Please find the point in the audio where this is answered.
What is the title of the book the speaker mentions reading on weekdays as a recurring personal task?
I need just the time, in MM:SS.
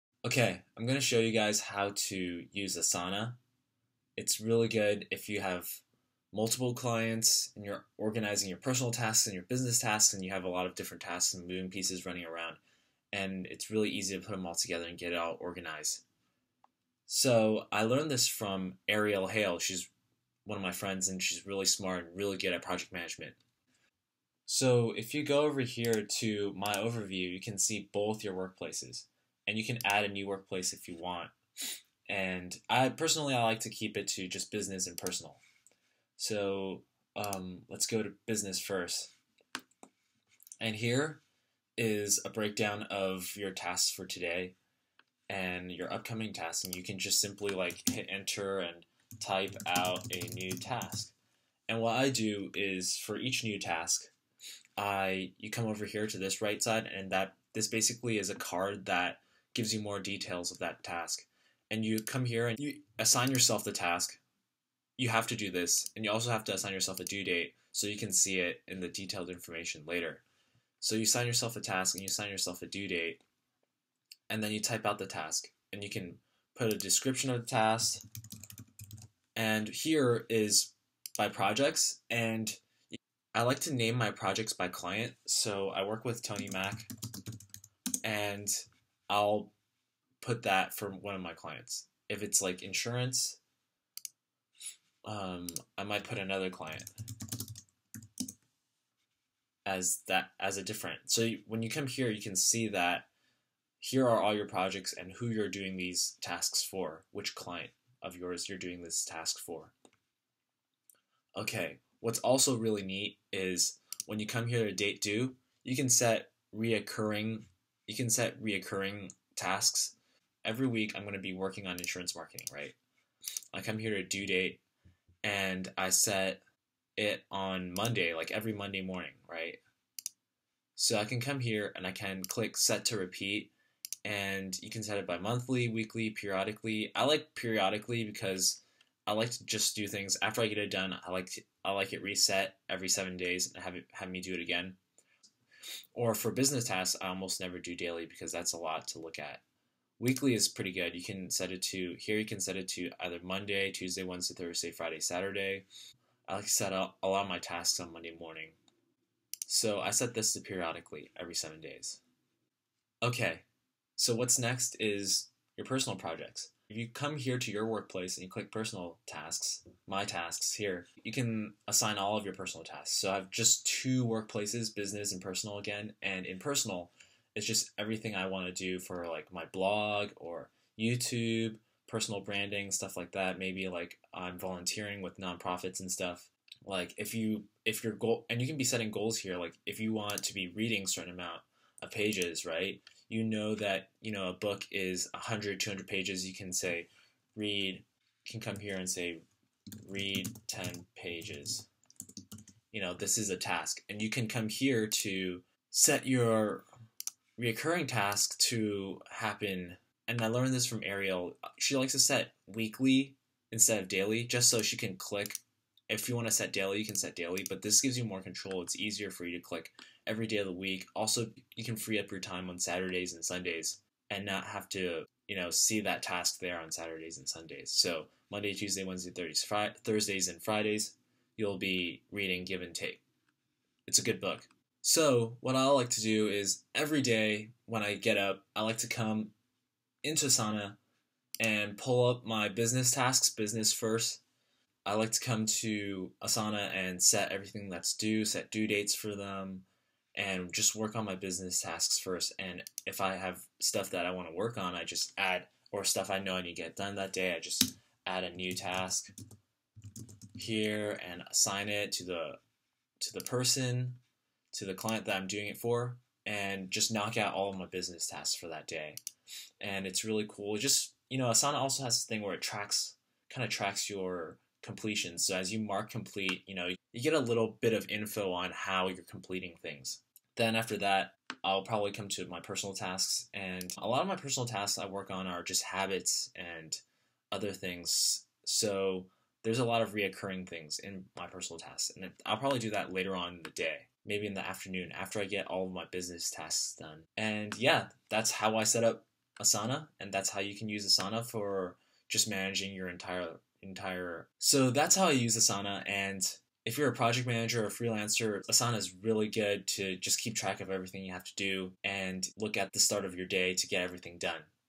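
03:52.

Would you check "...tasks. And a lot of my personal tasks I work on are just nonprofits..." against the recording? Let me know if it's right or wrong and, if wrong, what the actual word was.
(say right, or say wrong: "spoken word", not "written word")
wrong: "habits", not "nonprofits".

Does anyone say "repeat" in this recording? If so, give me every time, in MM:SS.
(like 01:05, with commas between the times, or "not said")
02:12.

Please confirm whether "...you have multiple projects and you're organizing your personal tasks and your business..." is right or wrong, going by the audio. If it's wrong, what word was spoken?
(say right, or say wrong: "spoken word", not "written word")
wrong: "clients", not "projects".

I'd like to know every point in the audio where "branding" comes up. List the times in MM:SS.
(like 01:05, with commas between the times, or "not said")
03:02.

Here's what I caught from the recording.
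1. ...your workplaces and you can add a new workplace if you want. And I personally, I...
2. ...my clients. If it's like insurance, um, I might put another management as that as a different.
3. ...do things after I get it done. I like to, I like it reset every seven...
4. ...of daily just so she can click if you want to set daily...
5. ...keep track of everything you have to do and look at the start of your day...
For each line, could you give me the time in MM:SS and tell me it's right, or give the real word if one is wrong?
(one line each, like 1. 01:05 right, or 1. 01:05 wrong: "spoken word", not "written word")
1. 00:28 right
2. 01:31 wrong: "client", not "management"
3. 02:19 right
4. 03:33 right
5. 05:10 right.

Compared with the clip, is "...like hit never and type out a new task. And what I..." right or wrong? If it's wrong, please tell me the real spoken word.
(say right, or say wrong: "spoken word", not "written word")
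wrong: "enter", not "never".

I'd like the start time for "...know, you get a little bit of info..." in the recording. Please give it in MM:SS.
04:36.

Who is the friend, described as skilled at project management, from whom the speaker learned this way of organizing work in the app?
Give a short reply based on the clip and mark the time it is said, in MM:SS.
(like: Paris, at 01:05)
Ariel Hale, at 00:18.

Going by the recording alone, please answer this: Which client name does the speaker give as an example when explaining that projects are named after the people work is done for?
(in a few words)
Tony Mack.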